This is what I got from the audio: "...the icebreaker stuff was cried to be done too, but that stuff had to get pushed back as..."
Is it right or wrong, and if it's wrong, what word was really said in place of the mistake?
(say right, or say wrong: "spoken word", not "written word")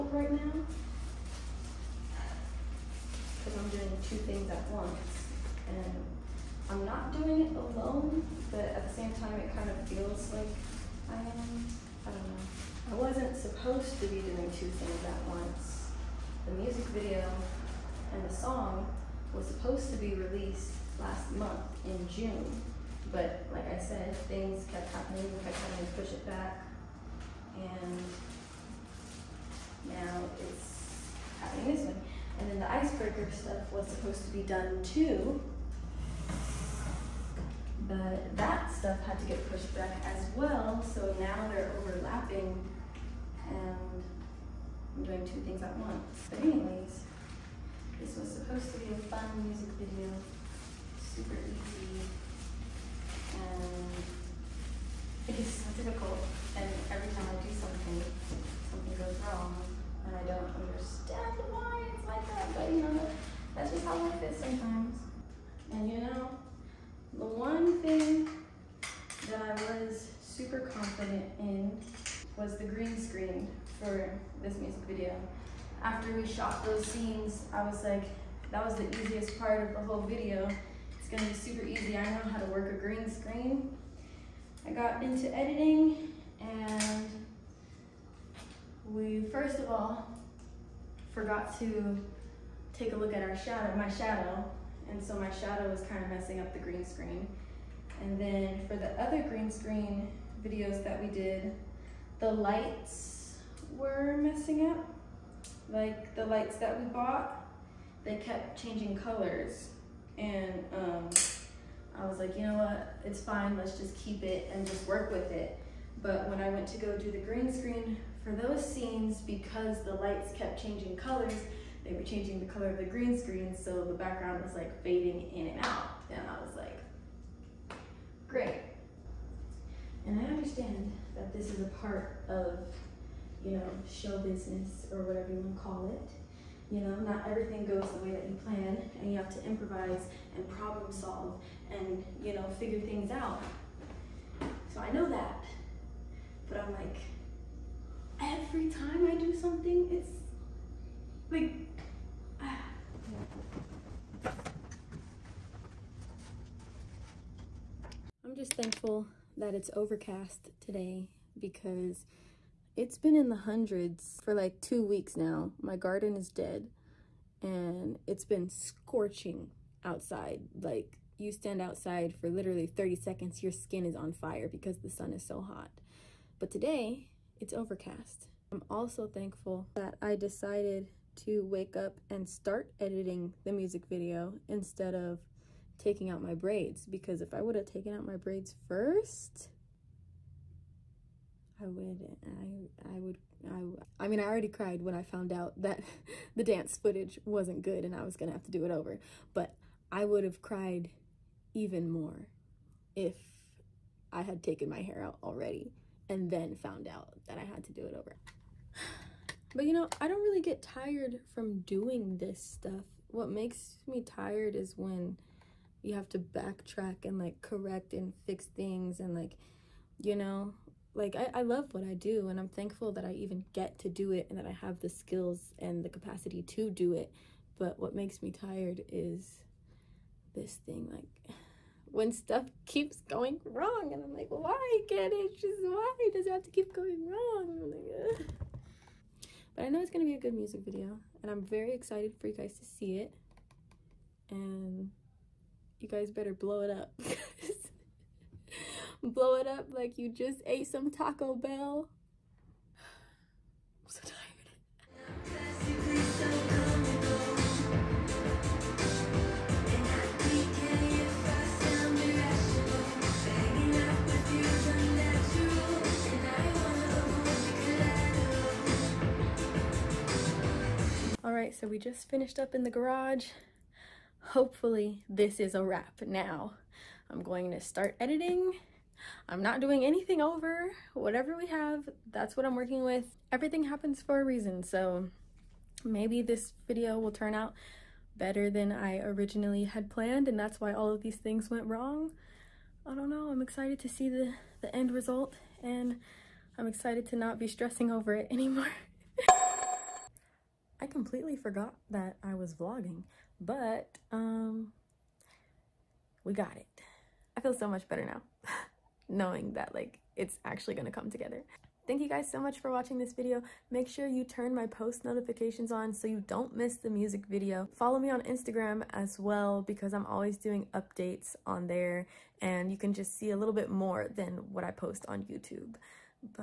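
wrong: "supposed", not "cried".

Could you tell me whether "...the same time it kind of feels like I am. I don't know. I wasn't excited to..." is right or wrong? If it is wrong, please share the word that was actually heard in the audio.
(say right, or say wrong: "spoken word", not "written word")
wrong: "supposed", not "excited".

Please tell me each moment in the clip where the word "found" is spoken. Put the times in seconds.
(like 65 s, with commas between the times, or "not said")
195 s, 206 s.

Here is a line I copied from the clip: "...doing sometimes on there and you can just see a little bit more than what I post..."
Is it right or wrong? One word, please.
wrong.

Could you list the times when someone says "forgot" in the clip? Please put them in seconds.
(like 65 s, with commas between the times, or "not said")
91 s, 301 s.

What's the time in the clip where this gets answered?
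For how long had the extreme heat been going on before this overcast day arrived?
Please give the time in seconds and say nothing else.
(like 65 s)
164 s.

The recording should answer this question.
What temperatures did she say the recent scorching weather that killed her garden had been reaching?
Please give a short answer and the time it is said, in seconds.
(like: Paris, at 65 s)
in the hundreds, at 163 s.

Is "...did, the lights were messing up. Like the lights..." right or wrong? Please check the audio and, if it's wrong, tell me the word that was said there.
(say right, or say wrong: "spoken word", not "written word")
right.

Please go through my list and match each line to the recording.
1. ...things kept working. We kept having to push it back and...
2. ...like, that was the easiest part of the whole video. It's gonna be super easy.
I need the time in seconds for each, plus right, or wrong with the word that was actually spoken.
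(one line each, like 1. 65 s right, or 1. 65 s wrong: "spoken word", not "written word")
1. 24 s wrong: "happening", not "working"
2. 77 s right.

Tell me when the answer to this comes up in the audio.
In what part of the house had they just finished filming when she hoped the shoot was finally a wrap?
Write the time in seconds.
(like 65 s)
272 s.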